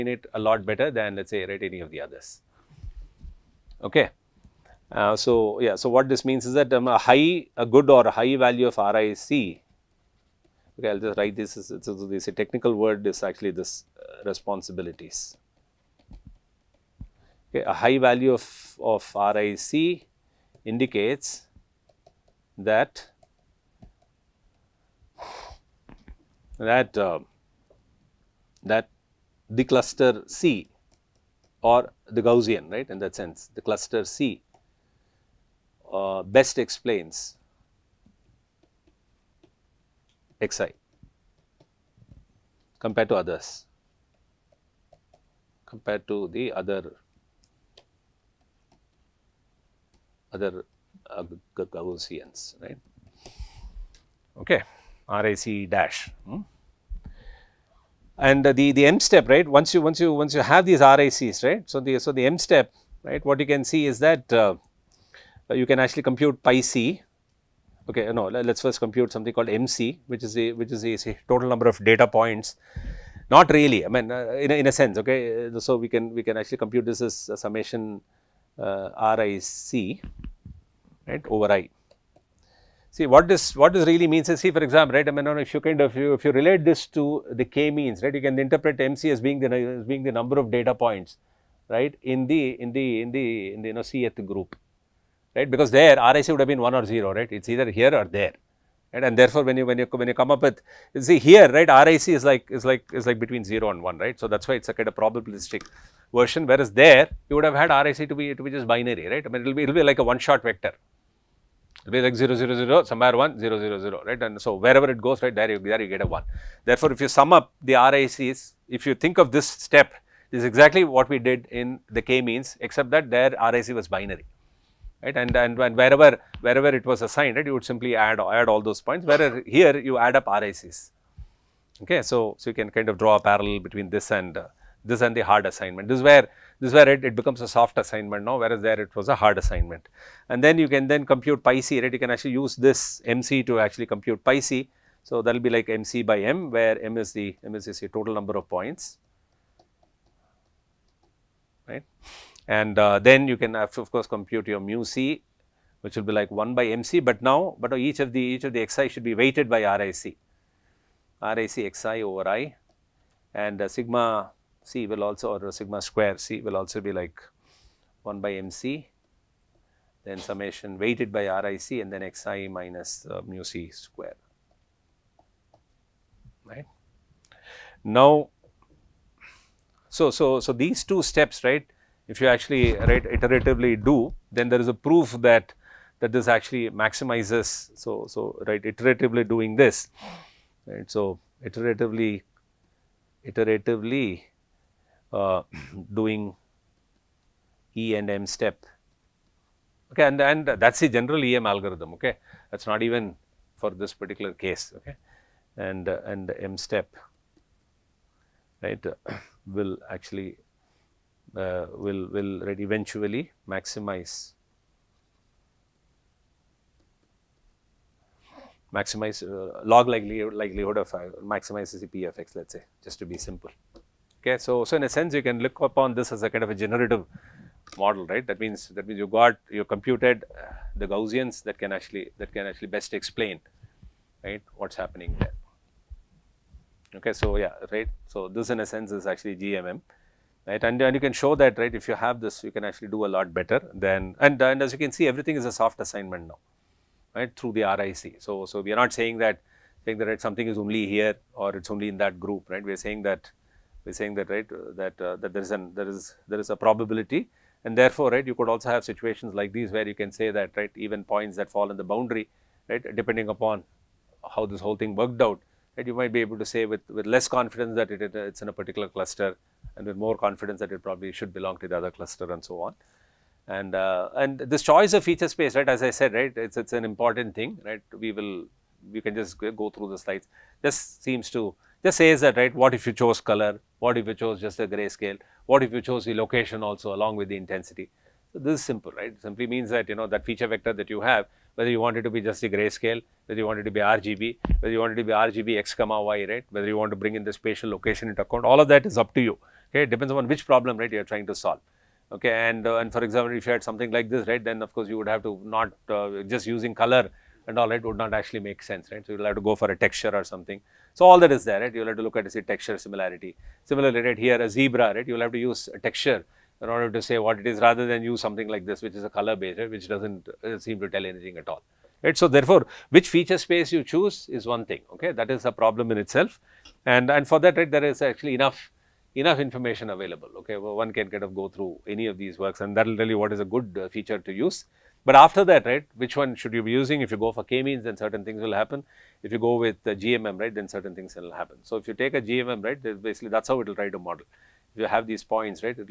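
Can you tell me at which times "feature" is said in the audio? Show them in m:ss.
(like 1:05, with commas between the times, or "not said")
4:35, 4:50, 5:23, 5:33.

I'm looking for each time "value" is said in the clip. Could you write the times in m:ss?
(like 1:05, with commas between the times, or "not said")
0:08, 0:17.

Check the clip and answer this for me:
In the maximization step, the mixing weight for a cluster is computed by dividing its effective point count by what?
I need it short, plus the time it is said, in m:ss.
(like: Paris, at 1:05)
total number of points, at 2:27.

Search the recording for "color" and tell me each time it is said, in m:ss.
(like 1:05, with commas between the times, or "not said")
4:43, 5:06, 5:19.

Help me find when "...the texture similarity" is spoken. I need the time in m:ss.
5:12.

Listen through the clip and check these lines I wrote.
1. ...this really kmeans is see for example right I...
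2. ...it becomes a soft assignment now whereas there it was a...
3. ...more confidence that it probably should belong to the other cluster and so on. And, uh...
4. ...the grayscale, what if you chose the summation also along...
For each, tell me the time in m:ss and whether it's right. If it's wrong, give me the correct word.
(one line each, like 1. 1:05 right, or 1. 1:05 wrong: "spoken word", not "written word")
1. 1:23 wrong: "means", not "kmeans"
2. 2:17 right
3. 4:29 right
4. 4:44 wrong: "location", not "summation".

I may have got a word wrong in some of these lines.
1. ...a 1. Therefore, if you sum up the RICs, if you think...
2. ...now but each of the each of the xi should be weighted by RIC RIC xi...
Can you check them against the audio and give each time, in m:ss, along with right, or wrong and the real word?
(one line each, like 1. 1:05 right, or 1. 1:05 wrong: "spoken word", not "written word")
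1. 1:56 right
2. 2:37 right.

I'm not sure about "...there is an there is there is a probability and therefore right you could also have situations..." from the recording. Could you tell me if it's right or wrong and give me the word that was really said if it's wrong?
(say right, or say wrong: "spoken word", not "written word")
right.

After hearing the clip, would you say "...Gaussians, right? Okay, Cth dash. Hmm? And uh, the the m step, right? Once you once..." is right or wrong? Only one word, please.
wrong.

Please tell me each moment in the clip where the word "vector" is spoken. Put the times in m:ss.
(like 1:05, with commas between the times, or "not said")
1:50, 4:50.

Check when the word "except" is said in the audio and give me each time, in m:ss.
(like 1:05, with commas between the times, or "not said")
2:02.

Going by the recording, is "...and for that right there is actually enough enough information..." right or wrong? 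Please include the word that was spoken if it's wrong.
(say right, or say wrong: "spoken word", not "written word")
right.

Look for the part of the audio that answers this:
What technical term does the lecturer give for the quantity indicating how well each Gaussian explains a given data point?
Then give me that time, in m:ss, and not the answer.
0:14.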